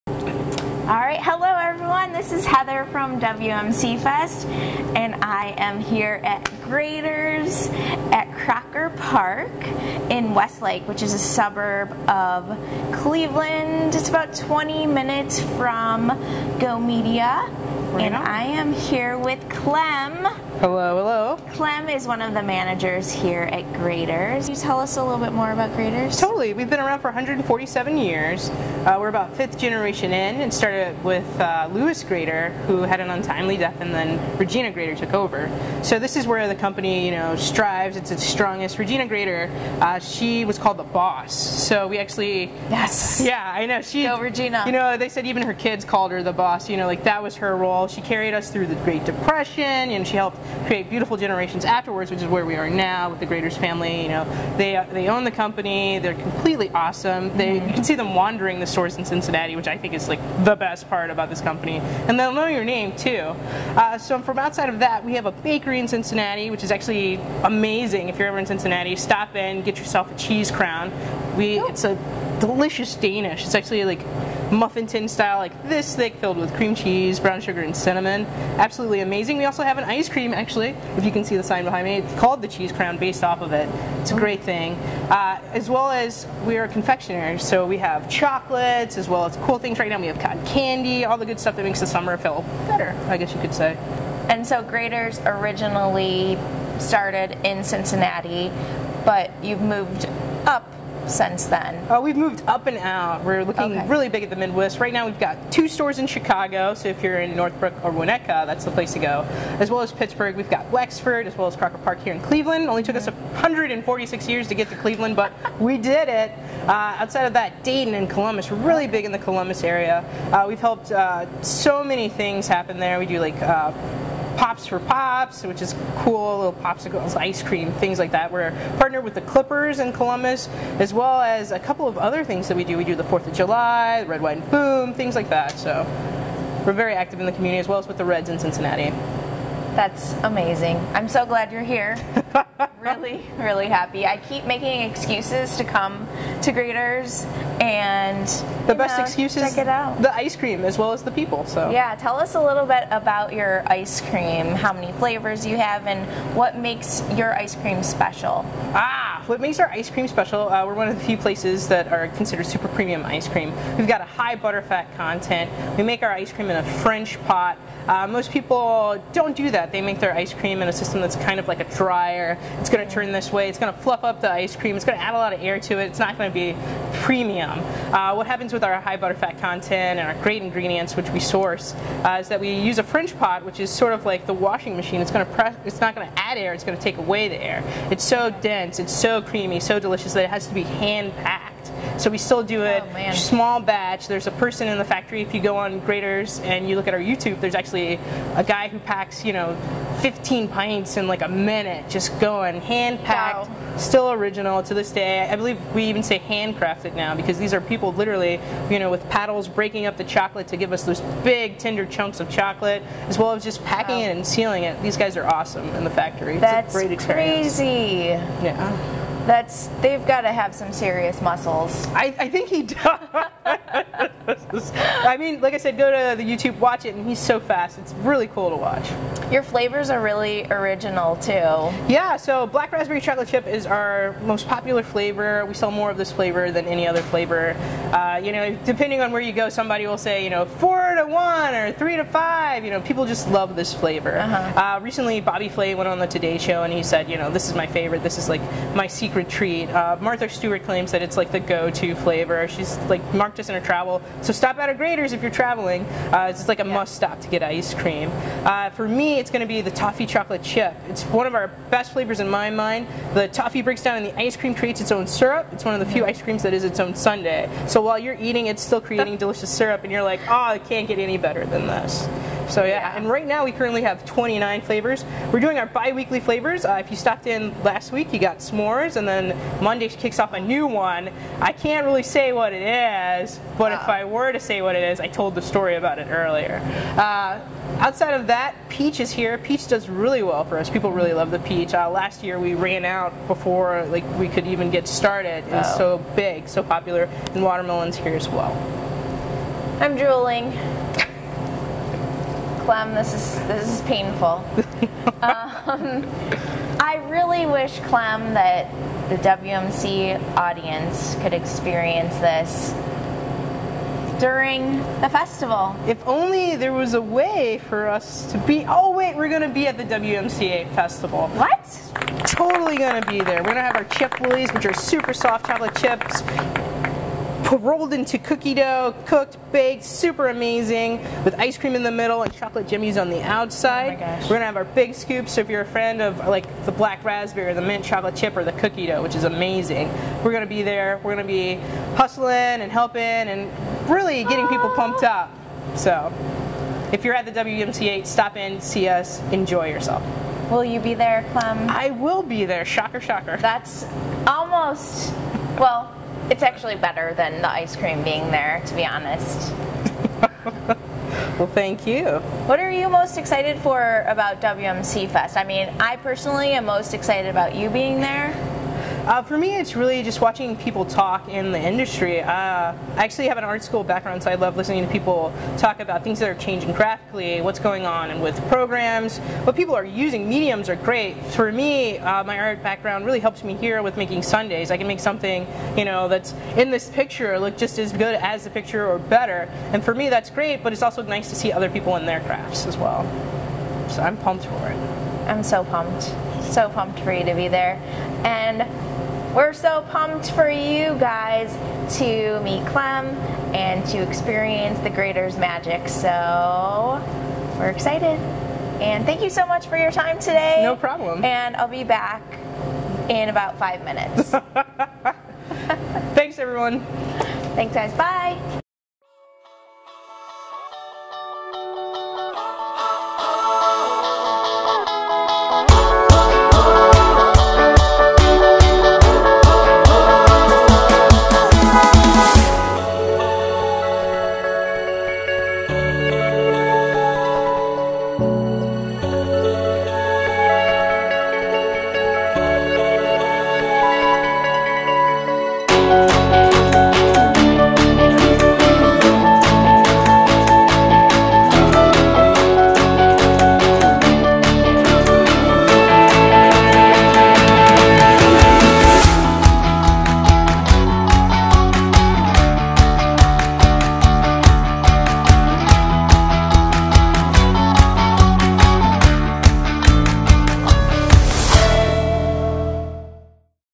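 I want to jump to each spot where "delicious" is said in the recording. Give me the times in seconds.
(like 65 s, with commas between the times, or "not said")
72 s, 189 s, 269 s.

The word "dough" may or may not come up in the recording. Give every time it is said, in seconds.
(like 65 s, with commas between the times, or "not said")
328 s, 338 s.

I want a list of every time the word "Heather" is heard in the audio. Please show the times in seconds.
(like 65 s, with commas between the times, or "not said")
2 s.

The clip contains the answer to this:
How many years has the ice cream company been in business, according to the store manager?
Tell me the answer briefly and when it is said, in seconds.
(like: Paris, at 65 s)
147, at 27 s.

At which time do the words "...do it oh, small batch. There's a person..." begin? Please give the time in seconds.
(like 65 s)
192 s.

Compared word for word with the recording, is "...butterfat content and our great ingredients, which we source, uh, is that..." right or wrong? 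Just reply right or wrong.
right.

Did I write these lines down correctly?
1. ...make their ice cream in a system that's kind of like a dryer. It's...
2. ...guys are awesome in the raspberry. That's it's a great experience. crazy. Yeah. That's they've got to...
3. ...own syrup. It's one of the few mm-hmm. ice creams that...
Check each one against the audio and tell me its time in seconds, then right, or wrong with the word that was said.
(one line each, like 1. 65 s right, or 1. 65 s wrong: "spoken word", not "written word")
1. 169 s right
2. 214 s wrong: "factory", not "raspberry"
3. 264 s right.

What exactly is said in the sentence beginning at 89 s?
We have cotton candy, all the good stuff that makes the summer feel better, I guess you could say.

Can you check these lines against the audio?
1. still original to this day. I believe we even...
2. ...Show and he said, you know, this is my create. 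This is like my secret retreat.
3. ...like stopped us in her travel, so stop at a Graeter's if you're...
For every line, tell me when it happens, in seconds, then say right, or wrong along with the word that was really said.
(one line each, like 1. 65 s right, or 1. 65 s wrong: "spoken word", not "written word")
1. 203 s right
2. 246 s wrong: "favorite", not "create"
3. 252 s wrong: "marked", not "stopped".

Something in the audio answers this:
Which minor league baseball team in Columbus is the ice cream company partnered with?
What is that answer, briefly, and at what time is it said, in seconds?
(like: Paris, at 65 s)
the Clippers, at 129 s.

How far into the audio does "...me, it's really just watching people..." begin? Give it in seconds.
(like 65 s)
369 s.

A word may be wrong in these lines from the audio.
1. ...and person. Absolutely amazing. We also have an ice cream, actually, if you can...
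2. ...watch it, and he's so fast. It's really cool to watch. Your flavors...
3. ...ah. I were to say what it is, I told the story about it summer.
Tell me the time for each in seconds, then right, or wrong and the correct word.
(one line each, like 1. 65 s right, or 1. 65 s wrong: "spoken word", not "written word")
1. 77 s wrong: "cinnamon", not "person"
2. 226 s right
3. 283 s wrong: "earlier", not "summer".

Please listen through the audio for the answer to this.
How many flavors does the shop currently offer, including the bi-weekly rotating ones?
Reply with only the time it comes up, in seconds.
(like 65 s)
274 s.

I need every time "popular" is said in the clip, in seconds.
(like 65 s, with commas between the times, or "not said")
234 s, 296 s.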